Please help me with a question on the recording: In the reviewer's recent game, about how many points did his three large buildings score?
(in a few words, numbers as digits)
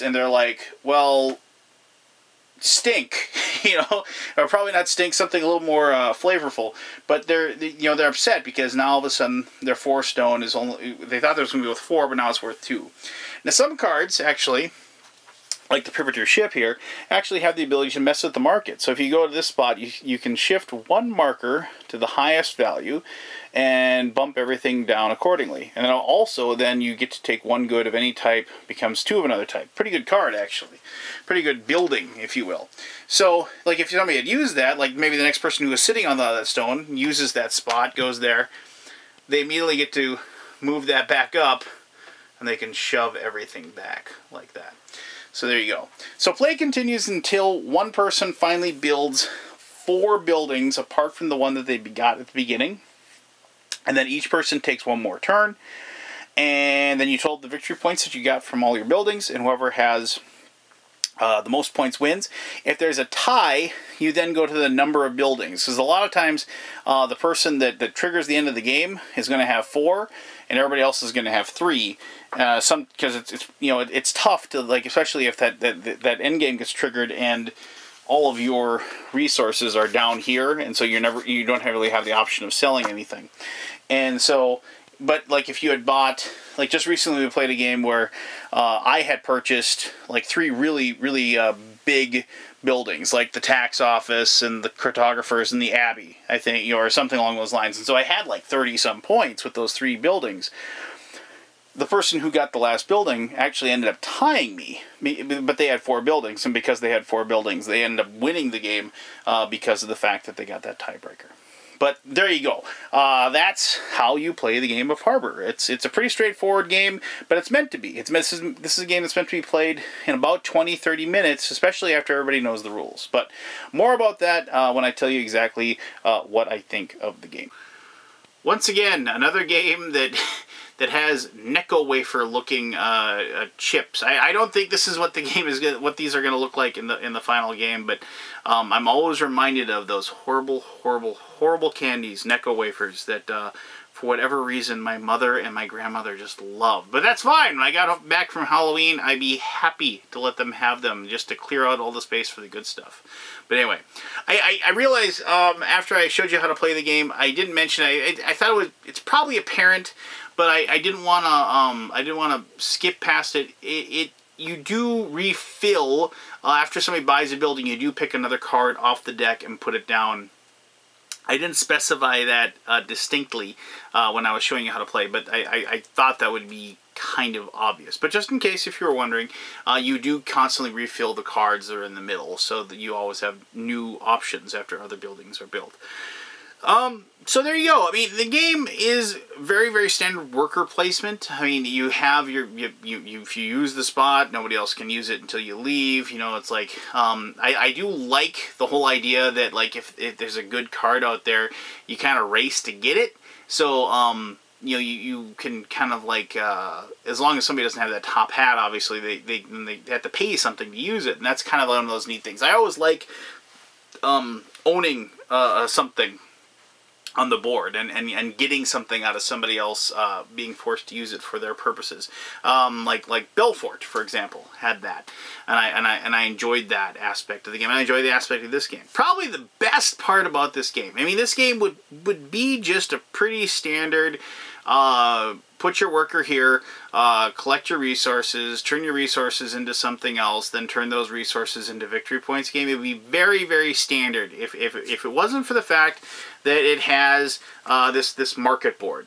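30 some.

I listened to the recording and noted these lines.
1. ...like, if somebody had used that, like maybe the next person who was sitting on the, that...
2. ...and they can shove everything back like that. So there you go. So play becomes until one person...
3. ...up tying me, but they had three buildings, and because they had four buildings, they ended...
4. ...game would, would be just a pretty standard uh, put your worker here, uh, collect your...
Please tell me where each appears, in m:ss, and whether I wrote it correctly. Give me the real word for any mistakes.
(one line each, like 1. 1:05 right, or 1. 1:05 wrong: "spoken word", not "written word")
1. 0:33 right
2. 0:42 wrong: "continues", not "becomes"
3. 1:43 wrong: "four", not "three"
4. 3:51 right.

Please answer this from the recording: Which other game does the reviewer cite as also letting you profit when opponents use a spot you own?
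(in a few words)
Belfort.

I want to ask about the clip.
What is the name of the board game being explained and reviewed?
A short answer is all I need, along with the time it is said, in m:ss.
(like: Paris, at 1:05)
Harbour, at 1:55.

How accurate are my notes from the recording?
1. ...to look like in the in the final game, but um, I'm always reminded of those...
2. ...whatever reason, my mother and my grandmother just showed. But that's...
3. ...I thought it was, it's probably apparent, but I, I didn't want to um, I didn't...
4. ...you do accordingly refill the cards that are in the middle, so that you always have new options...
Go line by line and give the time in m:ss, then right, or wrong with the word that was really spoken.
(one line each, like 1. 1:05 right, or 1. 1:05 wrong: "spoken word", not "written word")
1. 2:16 right
2. 2:24 wrong: "loved", not "showed"
3. 2:38 right
4. 2:59 wrong: "constantly", not "accordingly".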